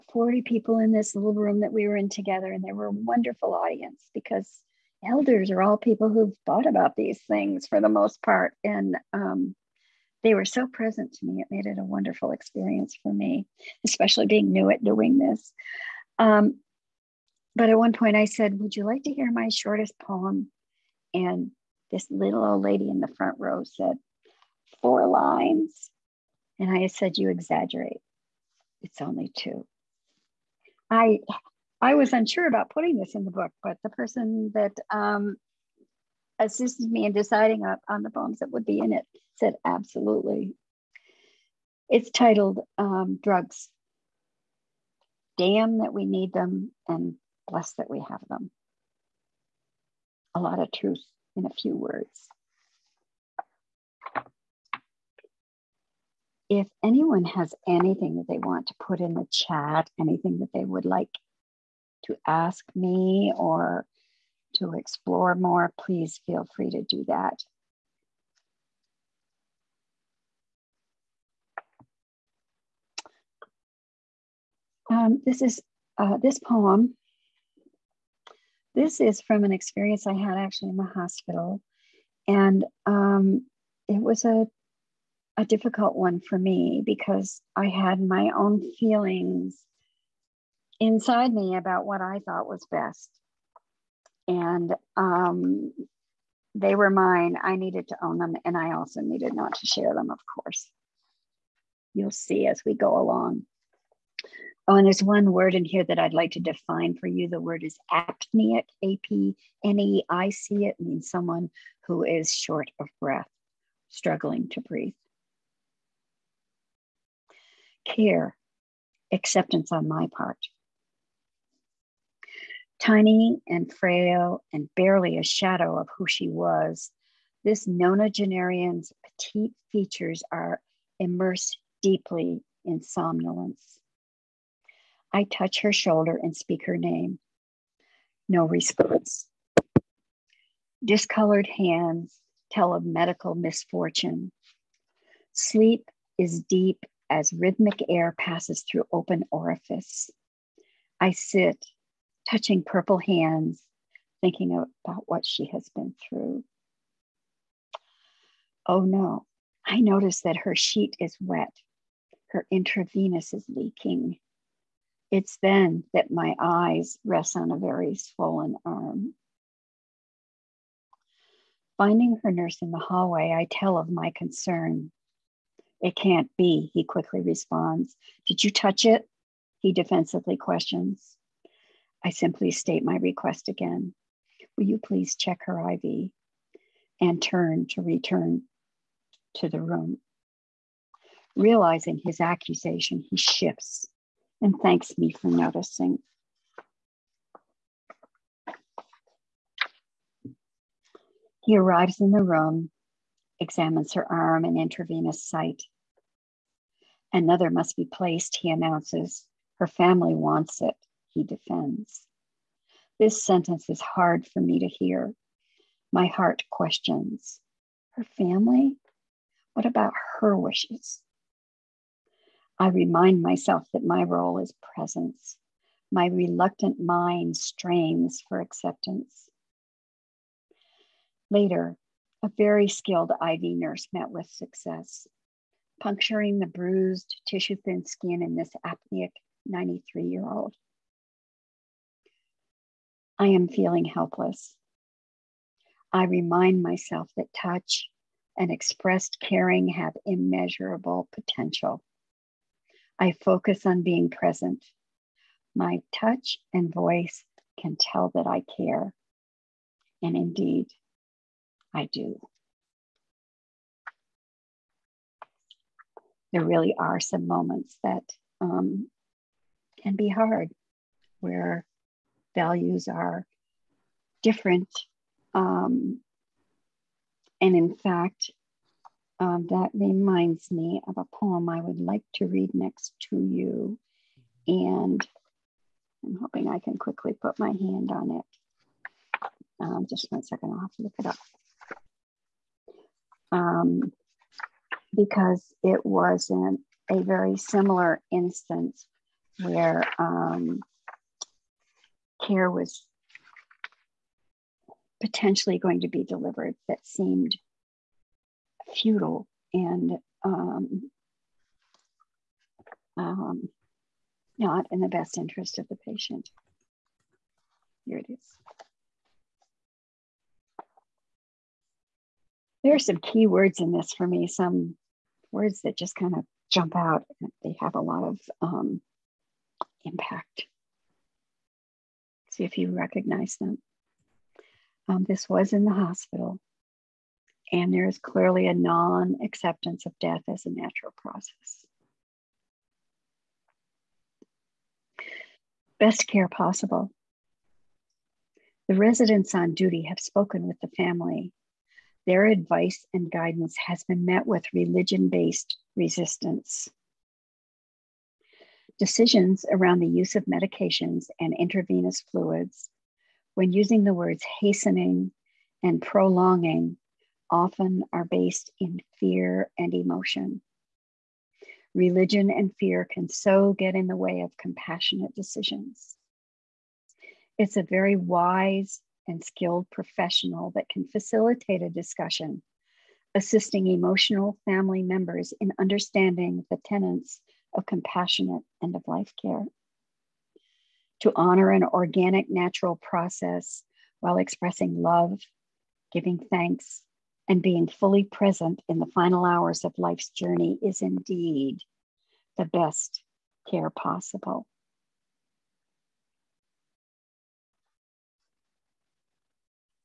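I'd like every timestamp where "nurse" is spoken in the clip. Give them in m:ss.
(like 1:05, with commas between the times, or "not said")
2:52, 3:53.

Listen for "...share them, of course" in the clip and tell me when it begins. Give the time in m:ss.
1:39.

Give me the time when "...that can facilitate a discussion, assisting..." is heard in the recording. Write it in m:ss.
6:20.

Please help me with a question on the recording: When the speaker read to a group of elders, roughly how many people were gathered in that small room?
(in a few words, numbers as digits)
40.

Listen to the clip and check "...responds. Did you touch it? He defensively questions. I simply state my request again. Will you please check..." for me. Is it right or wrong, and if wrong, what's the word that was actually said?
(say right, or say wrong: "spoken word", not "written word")
right.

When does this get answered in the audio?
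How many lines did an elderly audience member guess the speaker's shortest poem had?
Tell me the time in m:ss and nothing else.
0:24.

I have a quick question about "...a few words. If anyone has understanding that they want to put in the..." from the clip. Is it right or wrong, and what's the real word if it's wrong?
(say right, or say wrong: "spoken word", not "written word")
wrong: "anything", not "understanding".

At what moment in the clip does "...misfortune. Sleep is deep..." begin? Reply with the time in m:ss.
2:23.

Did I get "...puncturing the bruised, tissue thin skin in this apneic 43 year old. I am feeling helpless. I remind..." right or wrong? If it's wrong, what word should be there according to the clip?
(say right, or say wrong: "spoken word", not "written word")
wrong: "93", not "43".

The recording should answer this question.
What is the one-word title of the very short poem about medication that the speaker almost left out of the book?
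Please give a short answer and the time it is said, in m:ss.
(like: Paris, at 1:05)
Drugs, at 0:43.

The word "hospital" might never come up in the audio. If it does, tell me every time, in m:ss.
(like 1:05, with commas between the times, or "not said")
1:20, 5:35.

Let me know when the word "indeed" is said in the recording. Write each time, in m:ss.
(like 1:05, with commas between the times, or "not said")
4:20, 6:40.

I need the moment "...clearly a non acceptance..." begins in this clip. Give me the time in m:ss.
5:37.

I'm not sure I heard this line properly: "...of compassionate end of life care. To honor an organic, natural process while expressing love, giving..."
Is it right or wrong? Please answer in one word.
right.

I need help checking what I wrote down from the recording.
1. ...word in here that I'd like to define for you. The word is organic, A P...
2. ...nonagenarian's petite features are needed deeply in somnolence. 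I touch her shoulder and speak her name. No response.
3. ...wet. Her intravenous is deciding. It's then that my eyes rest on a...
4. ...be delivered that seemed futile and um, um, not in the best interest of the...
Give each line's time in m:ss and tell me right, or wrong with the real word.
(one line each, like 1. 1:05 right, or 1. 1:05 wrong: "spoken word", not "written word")
1. 1:45 wrong: "apneic", not "organic"
2. 2:07 wrong: "immersed", not "needed"
3. 2:41 wrong: "leaking", not "deciding"
4. 5:05 right.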